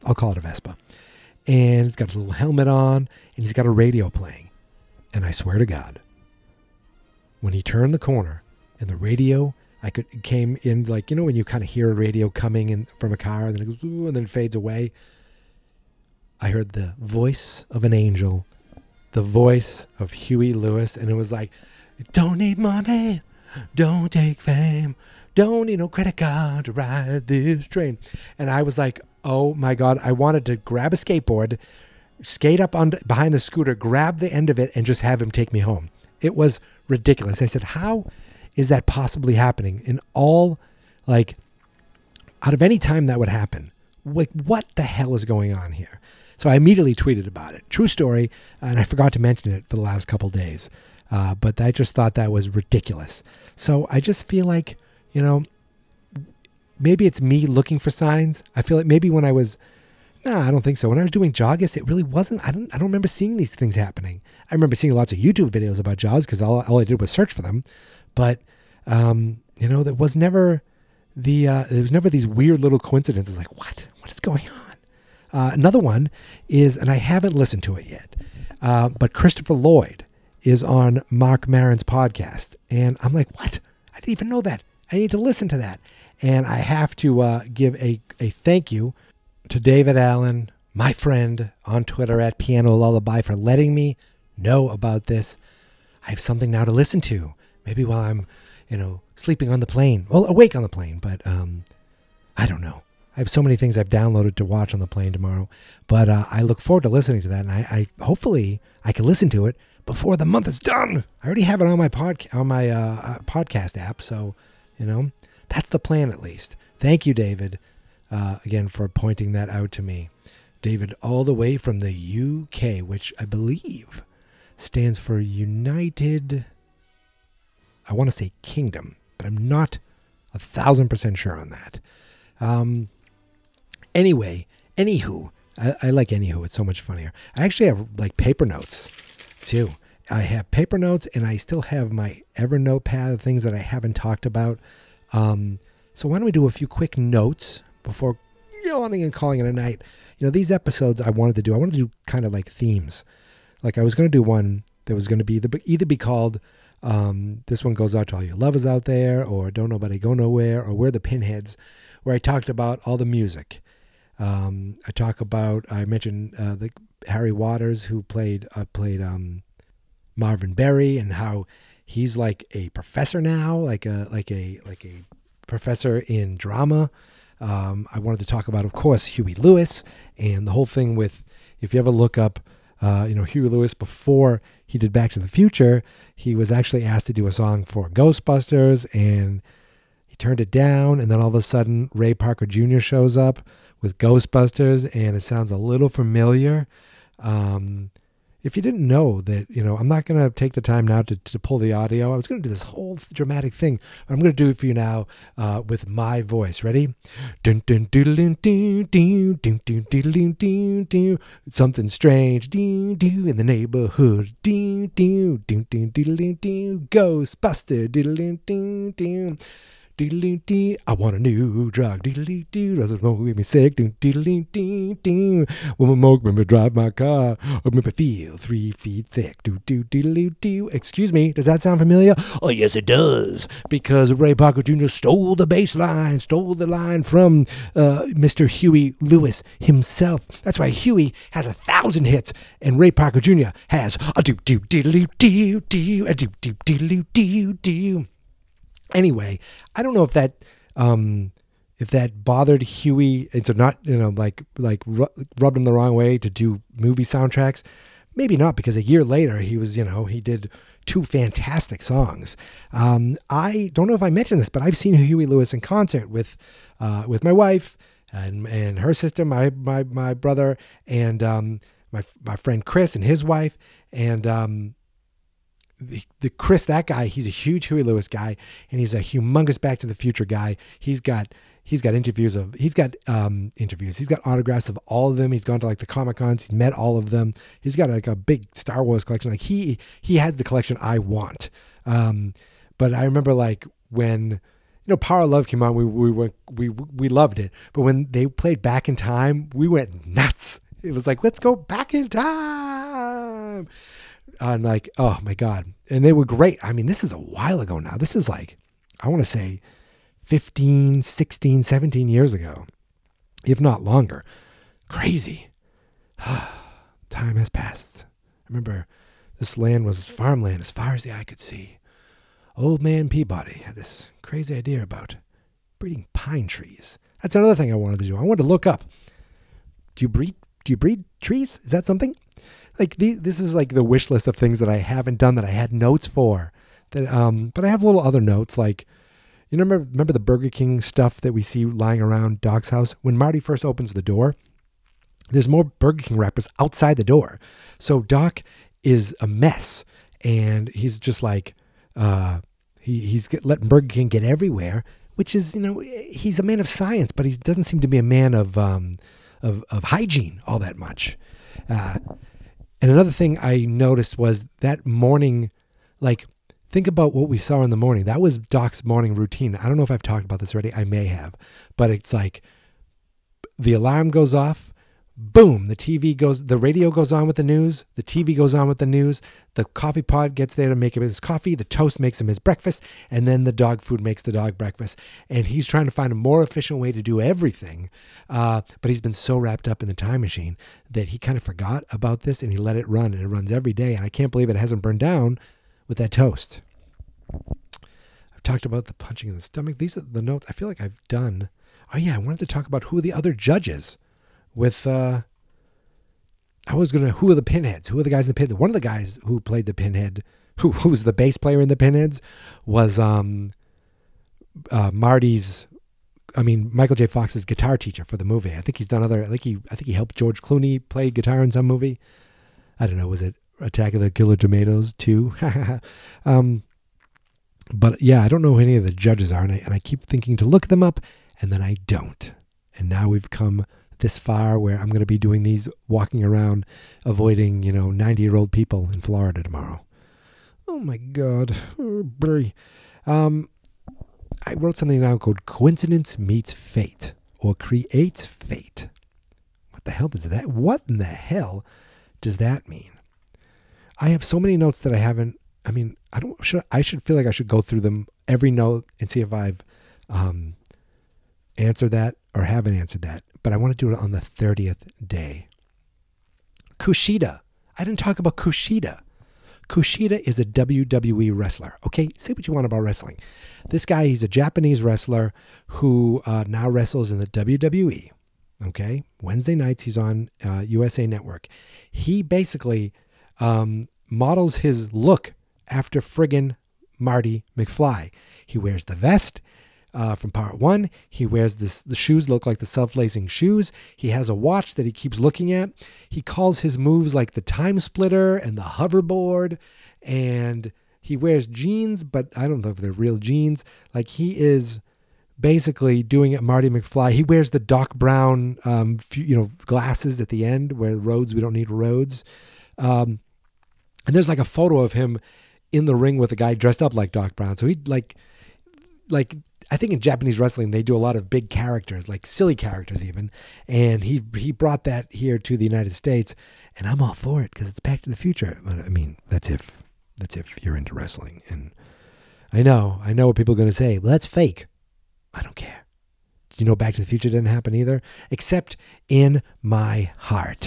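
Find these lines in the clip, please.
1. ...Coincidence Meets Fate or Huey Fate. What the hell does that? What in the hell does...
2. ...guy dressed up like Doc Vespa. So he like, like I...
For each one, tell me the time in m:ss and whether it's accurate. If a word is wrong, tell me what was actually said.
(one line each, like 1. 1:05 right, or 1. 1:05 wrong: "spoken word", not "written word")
1. 7:25 wrong: "Creates", not "Huey"
2. 8:36 wrong: "Brown", not "Vespa".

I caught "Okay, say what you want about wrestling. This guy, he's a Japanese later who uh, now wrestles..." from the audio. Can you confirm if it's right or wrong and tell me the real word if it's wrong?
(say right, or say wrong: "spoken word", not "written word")
wrong: "wrestler", not "later".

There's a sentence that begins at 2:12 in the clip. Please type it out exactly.
Um, anyway, anywho, I, I like anywho.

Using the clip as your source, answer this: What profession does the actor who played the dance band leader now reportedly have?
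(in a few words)
professor in drama.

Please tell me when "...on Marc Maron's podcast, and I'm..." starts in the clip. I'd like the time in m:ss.
1:20.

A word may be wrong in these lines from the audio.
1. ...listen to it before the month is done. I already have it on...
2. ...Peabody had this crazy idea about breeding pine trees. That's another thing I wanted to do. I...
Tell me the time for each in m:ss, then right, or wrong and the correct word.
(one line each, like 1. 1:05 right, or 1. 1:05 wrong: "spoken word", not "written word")
1. 1:49 right
2. 5:23 right.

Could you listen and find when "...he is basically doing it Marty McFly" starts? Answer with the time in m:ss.
8:24.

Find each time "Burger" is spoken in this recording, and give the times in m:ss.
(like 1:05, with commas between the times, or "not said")
5:40, 5:45, 5:53.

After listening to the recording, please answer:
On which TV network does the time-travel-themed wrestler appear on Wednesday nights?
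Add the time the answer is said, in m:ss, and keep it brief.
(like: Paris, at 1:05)
USA Network, at 8:00.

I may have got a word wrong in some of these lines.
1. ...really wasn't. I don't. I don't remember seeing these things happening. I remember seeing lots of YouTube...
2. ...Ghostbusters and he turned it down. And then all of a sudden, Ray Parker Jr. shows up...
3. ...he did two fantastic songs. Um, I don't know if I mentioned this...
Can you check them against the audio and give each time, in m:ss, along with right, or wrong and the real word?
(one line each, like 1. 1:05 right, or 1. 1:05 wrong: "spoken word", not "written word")
1. 1:01 right
2. 3:07 right
3. 4:20 right.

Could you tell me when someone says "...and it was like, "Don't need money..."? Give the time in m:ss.
0:20.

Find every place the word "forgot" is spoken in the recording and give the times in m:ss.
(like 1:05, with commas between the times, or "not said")
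0:48, 6:31.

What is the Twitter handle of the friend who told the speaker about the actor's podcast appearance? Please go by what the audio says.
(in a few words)
Piano Lullaby.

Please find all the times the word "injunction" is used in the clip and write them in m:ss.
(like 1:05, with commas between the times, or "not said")
not said.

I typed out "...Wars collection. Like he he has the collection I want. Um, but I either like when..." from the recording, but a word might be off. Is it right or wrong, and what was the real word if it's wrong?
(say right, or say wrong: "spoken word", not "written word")
wrong: "remember", not "either".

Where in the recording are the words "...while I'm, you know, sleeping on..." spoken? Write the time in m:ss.
1:37.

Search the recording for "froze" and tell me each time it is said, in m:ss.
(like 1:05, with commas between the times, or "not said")
not said.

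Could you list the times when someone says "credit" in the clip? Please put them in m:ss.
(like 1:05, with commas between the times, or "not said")
0:25.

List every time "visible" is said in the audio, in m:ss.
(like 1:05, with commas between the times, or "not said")
not said.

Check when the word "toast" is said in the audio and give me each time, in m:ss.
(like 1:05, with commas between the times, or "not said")
6:21, 6:36.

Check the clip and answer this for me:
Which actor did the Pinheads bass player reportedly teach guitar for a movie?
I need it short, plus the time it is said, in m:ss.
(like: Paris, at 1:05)
George Clooney, at 7:00.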